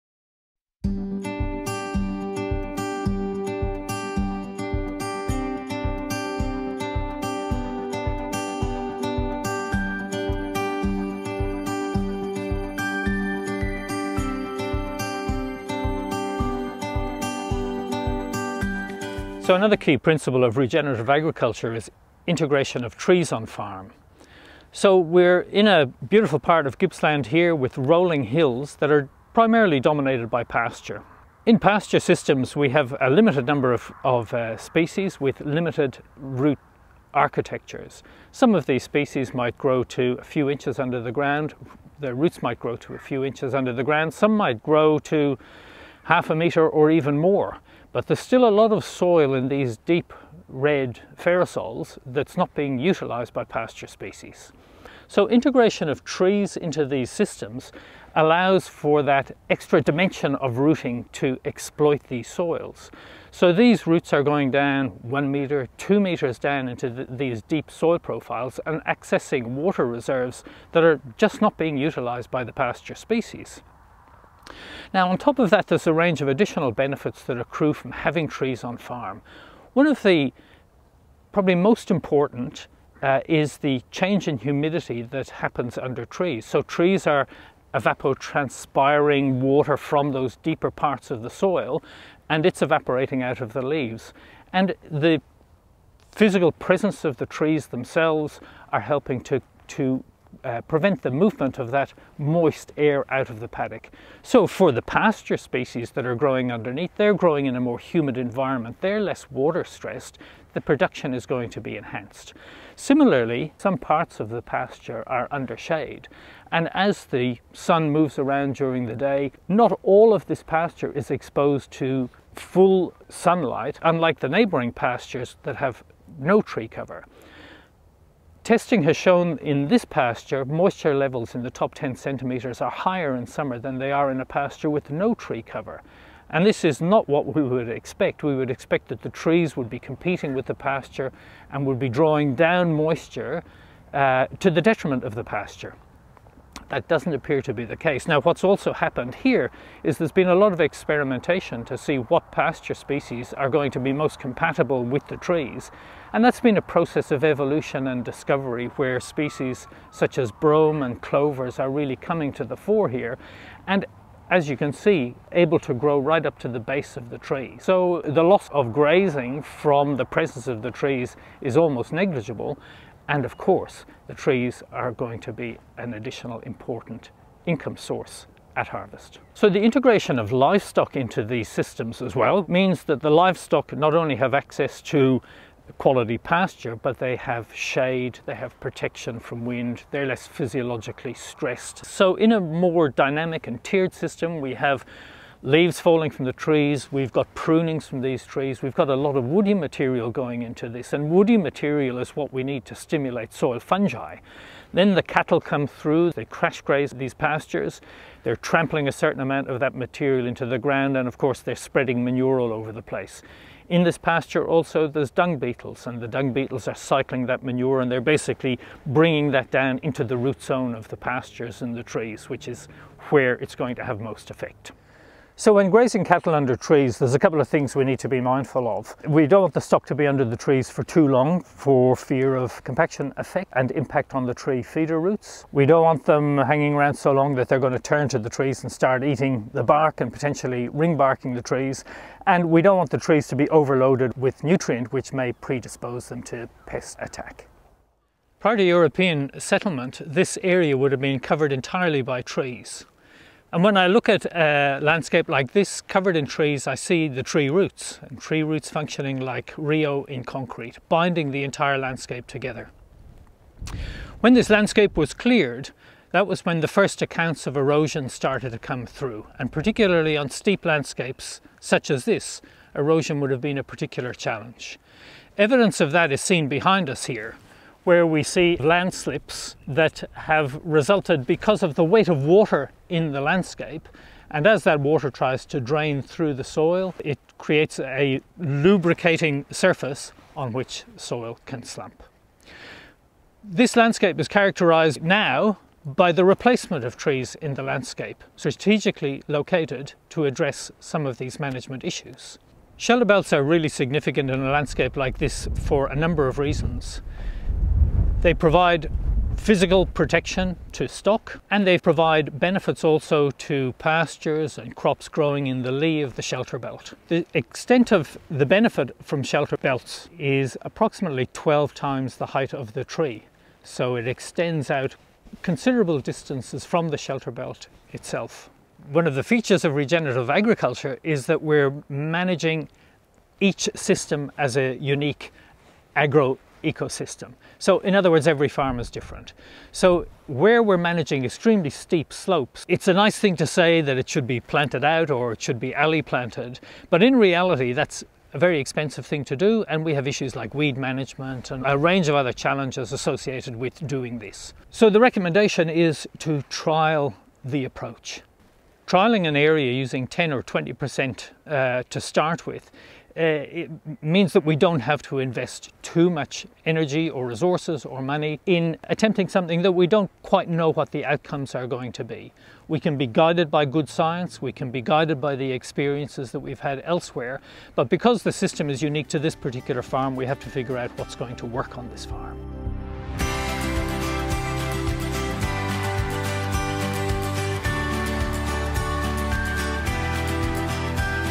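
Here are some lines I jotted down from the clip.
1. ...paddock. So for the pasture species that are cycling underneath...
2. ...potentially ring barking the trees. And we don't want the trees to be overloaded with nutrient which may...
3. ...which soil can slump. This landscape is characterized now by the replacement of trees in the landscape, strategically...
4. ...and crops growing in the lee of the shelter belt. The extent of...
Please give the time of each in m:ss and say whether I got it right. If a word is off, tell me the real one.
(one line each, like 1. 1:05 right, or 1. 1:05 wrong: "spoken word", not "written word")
1. 1:43 wrong: "growing", not "cycling"
2. 4:00 right
3. 4:50 right
4. 5:14 right.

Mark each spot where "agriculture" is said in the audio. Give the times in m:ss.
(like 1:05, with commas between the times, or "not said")
0:21, 5:30.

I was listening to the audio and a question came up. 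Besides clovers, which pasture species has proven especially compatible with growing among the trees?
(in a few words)
brome.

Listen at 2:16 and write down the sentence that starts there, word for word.
And this is not what we would expect.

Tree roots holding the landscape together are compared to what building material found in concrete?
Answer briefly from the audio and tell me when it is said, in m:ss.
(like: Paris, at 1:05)
reo, at 4:19.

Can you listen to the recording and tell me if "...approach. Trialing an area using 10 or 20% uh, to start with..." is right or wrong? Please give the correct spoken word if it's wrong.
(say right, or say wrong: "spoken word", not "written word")
right.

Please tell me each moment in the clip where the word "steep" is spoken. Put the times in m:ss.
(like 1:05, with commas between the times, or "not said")
4:30, 5:41.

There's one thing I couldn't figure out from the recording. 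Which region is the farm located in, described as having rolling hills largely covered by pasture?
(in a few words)
Gippsland.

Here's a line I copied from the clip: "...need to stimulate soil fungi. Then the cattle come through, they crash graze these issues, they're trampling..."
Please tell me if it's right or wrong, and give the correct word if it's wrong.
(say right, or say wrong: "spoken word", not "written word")
wrong: "pastures", not "issues".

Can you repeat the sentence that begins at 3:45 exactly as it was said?
So when grazing cattle under trees, there's a couple of things we need to be mindful of.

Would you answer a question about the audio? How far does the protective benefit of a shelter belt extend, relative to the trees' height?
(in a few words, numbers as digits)
12 times.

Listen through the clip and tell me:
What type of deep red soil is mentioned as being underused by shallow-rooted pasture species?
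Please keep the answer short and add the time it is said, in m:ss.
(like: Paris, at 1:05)
ferrosols, at 0:51.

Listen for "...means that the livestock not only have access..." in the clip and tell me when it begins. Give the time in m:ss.
3:02.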